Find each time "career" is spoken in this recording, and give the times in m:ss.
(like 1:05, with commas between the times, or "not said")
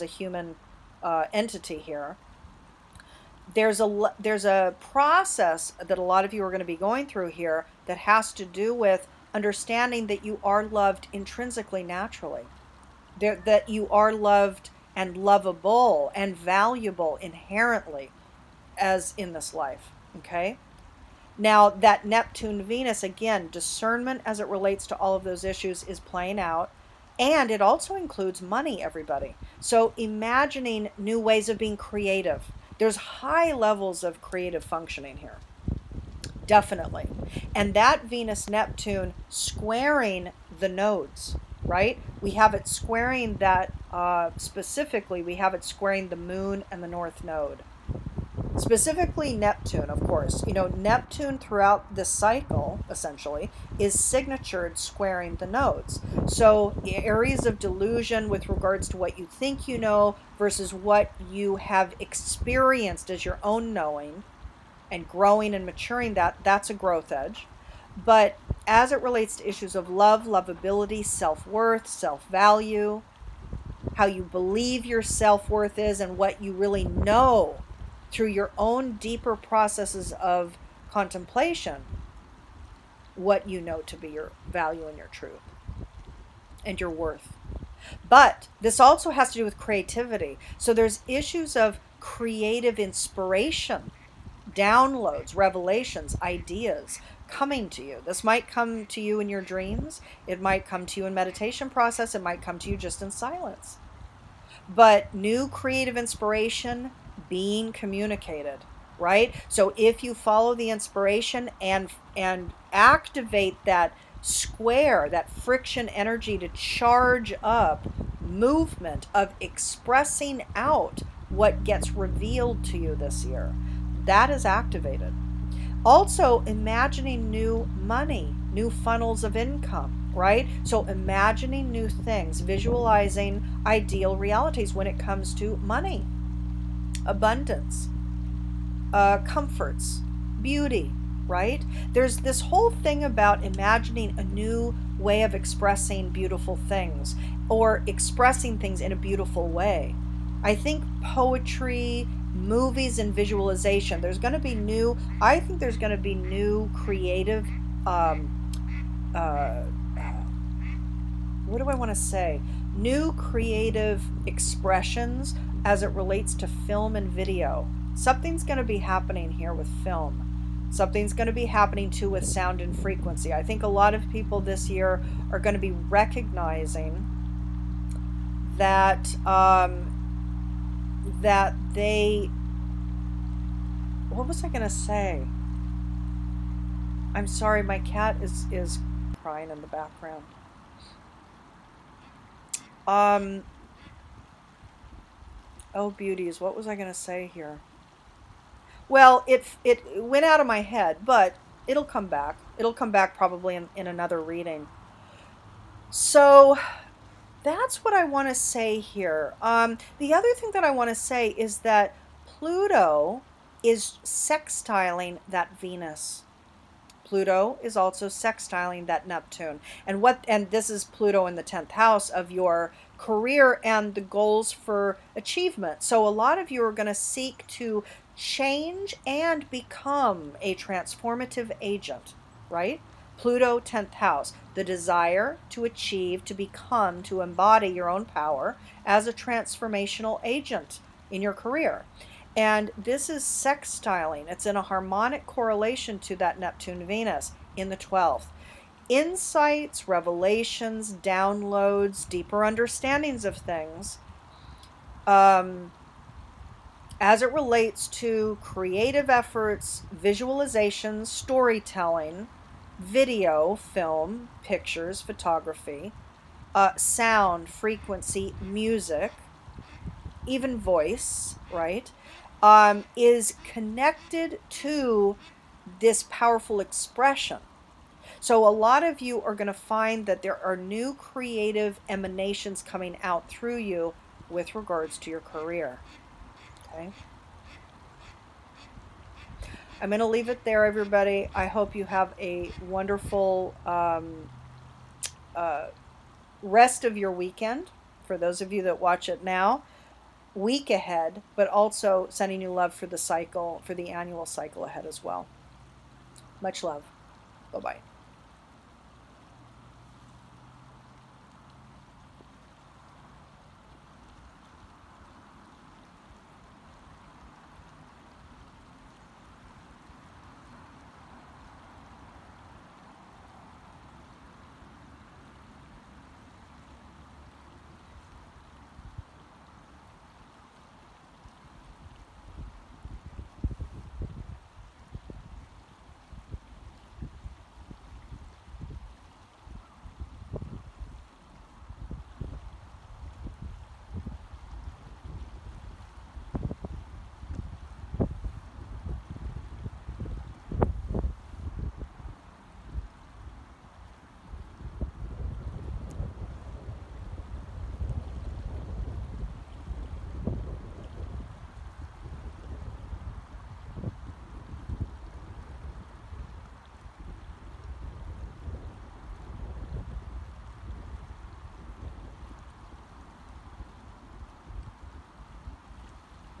3:42, 4:01, 4:45.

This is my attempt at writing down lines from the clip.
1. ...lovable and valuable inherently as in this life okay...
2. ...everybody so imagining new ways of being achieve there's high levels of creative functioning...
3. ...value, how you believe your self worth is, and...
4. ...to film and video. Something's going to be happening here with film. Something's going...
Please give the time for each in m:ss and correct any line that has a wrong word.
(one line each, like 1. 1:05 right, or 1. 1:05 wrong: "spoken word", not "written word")
1. 0:15 right
2. 0:28 wrong: "creative", not "achieve"
3. 1:12 right
4. 2:46 right.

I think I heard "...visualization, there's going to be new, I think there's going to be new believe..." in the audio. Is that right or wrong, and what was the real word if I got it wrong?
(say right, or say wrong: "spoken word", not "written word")
wrong: "creative", not "believe".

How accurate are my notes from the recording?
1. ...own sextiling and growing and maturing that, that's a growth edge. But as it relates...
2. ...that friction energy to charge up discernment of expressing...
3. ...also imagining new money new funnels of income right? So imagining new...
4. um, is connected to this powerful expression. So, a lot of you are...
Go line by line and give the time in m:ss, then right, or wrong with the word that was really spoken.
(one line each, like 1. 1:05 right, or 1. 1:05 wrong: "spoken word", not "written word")
1. 1:03 wrong: "knowing", not "sextiling"
2. 1:55 wrong: "movement", not "discernment"
3. 2:05 right
4. 4:32 right.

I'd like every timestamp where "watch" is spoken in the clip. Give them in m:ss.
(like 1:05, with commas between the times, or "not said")
4:58.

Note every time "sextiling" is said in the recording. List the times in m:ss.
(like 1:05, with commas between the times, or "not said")
3:34, 3:38, 4:03.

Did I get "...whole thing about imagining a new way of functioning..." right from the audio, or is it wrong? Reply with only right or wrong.
wrong.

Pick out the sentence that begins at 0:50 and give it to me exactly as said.
You know, Neptune throughout this cycle, essentially, is signatured squaring the nodes.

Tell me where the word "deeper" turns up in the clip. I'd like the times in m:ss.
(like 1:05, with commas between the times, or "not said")
1:18, 4:12.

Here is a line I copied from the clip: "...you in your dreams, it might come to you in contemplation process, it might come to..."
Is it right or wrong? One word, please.
wrong.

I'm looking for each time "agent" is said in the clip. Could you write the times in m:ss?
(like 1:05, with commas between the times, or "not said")
3:51, 4:00.